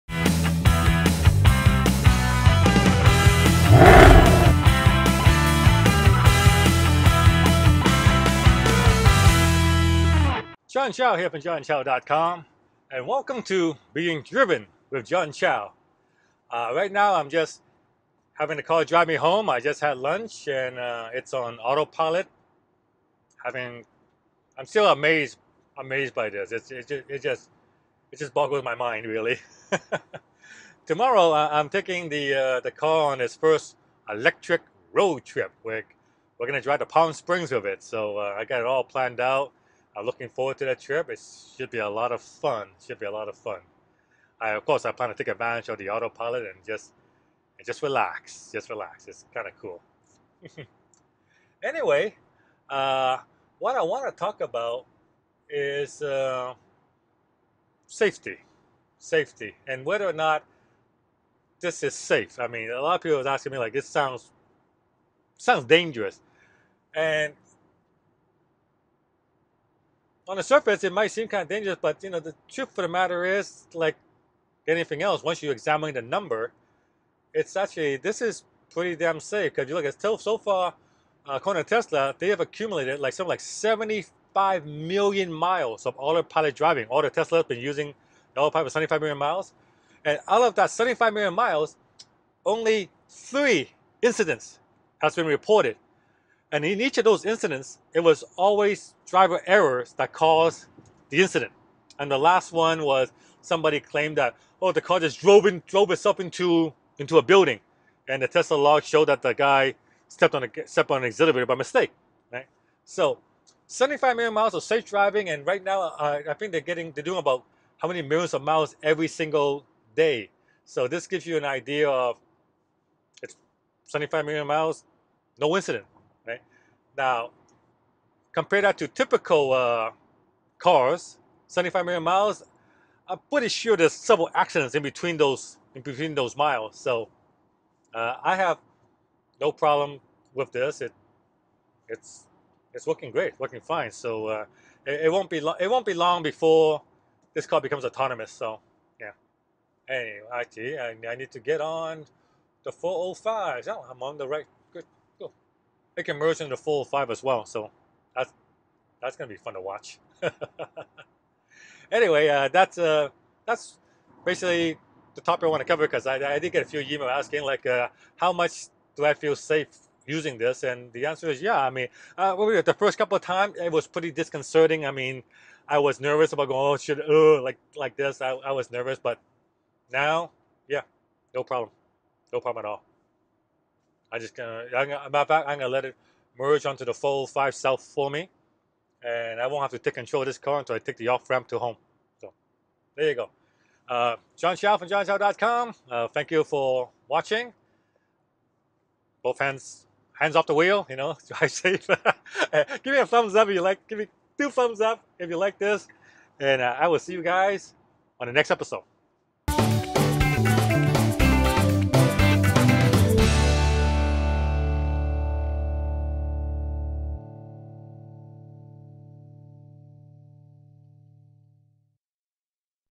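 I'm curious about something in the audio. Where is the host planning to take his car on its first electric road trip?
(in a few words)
Palm Springs.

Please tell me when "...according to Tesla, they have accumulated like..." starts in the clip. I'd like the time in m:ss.
1:21.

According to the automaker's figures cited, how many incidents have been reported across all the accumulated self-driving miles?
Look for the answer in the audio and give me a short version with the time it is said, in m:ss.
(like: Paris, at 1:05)
3, at 1:33.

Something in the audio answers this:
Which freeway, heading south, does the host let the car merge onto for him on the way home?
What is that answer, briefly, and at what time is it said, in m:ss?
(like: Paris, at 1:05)
The 5 South, at 3:06.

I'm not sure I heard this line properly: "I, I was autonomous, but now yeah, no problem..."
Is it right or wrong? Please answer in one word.
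wrong.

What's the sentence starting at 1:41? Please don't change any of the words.
And the last one was somebody claimed that, oh, the car just drove, in, drove itself into, into a building.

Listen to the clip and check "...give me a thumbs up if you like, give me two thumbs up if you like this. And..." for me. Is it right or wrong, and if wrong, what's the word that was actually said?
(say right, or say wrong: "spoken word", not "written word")
right.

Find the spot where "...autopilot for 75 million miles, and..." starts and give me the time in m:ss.
1:28.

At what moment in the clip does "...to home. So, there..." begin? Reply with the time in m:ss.
3:11.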